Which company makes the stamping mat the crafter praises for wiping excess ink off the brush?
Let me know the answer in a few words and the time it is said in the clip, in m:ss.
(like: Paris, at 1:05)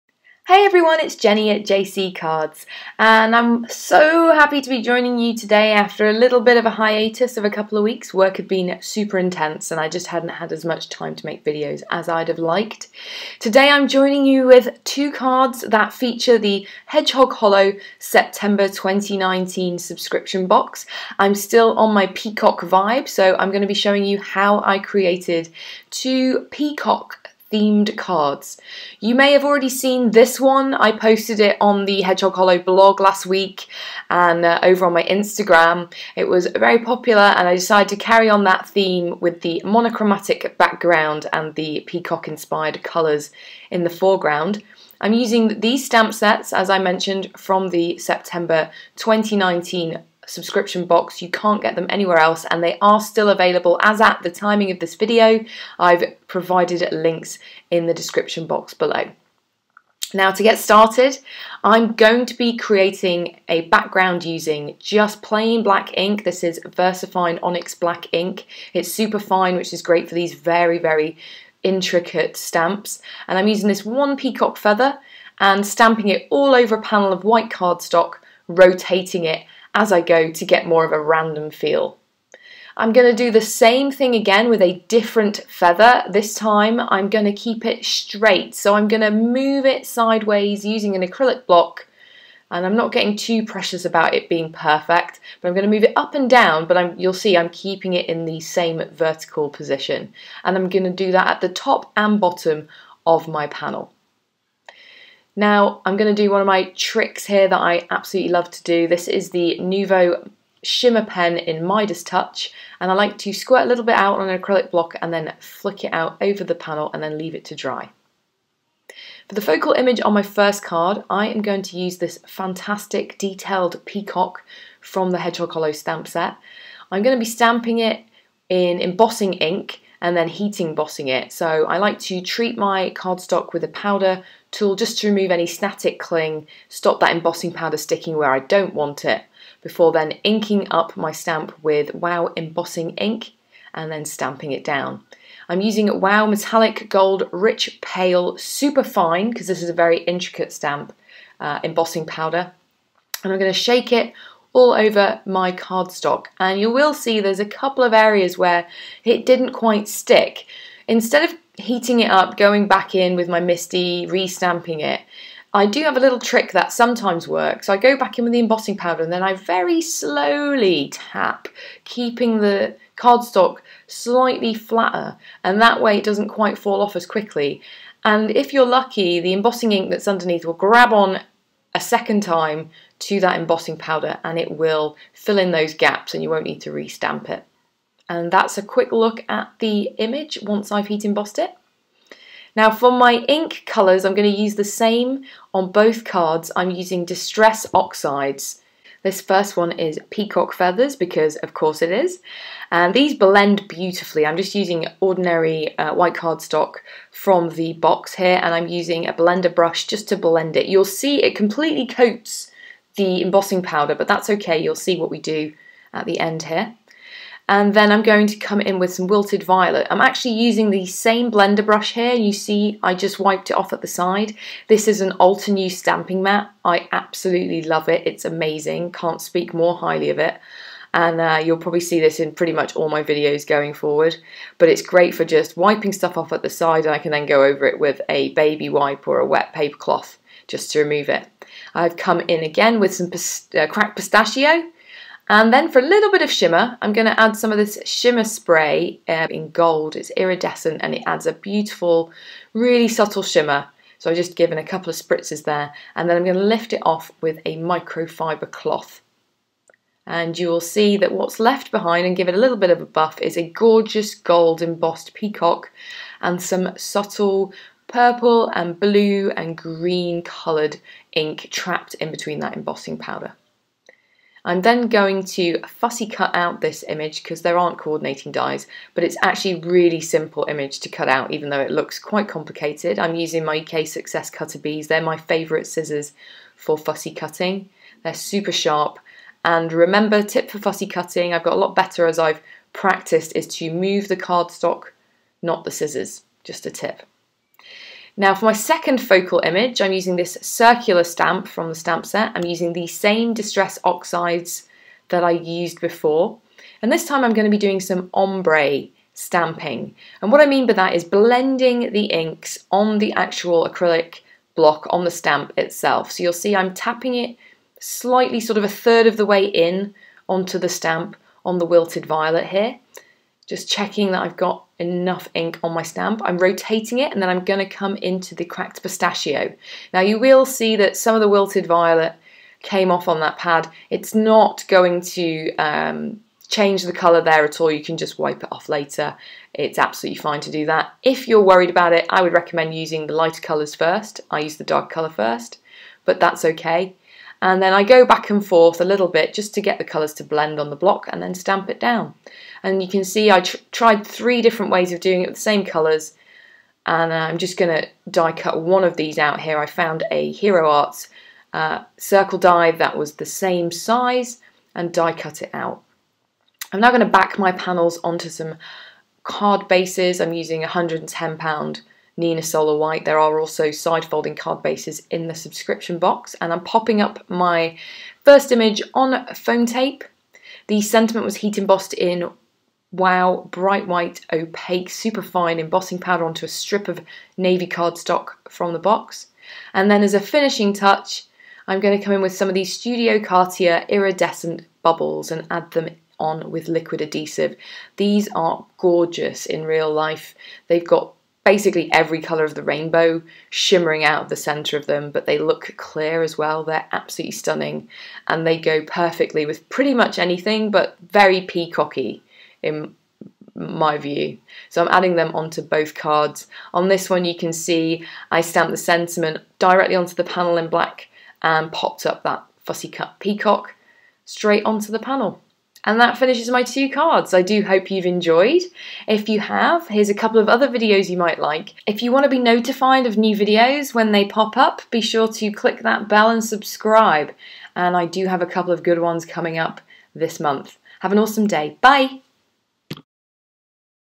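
Altenew, at 3:45.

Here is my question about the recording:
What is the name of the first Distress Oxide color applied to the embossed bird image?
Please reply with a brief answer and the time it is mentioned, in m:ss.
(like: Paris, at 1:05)
Peacock Feathers, at 3:20.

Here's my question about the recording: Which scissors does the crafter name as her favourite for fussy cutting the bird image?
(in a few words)
EK Success Cutter Bees.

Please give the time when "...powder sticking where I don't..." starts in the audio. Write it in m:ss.
2:17.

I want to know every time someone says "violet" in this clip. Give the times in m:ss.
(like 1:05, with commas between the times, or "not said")
3:39, 5:22, 5:31.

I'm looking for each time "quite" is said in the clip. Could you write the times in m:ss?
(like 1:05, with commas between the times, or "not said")
2:39, 2:56, 4:41.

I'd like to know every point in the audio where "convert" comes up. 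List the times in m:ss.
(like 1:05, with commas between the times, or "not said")
not said.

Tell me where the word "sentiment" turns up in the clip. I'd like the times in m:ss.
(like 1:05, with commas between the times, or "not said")
6:20, 6:58.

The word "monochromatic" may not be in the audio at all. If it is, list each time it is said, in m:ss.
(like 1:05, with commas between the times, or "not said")
0:39.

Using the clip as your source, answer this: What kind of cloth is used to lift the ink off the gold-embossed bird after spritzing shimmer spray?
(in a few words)
microfiber cloth.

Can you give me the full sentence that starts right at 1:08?
It's super fine, which is great for these very, very intricate stamps.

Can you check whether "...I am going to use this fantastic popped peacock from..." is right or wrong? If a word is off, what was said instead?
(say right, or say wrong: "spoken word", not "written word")
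wrong: "detailed", not "popped".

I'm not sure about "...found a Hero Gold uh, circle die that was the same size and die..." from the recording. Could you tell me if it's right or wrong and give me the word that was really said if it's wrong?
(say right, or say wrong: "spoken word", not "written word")
wrong: "Arts", not "Gold".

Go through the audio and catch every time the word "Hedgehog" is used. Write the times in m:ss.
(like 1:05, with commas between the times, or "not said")
0:16, 0:32, 2:05.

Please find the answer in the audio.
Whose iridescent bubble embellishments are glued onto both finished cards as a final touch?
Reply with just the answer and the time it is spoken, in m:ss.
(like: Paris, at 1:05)
Studio Katia, at 6:32.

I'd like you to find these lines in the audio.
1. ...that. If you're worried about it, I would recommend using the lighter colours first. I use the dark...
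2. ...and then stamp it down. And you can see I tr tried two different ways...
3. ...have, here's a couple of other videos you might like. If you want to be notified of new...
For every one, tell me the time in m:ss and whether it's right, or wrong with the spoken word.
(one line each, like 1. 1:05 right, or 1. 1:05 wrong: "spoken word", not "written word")
1. 5:40 right
2. 5:51 wrong: "three", not "two"
3. 7:09 right.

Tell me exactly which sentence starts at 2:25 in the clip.
I'm using WOW Metallic Gold Rich Pale Super Fine, because this is a very intricate stamp, uh, embossing powder.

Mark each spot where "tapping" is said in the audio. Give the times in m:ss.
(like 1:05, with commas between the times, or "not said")
5:16.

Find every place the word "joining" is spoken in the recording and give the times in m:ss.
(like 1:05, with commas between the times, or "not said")
0:04, 0:13.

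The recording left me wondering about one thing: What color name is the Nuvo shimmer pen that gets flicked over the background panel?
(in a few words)
Midas Touch.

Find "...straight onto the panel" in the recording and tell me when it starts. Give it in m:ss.
7:04.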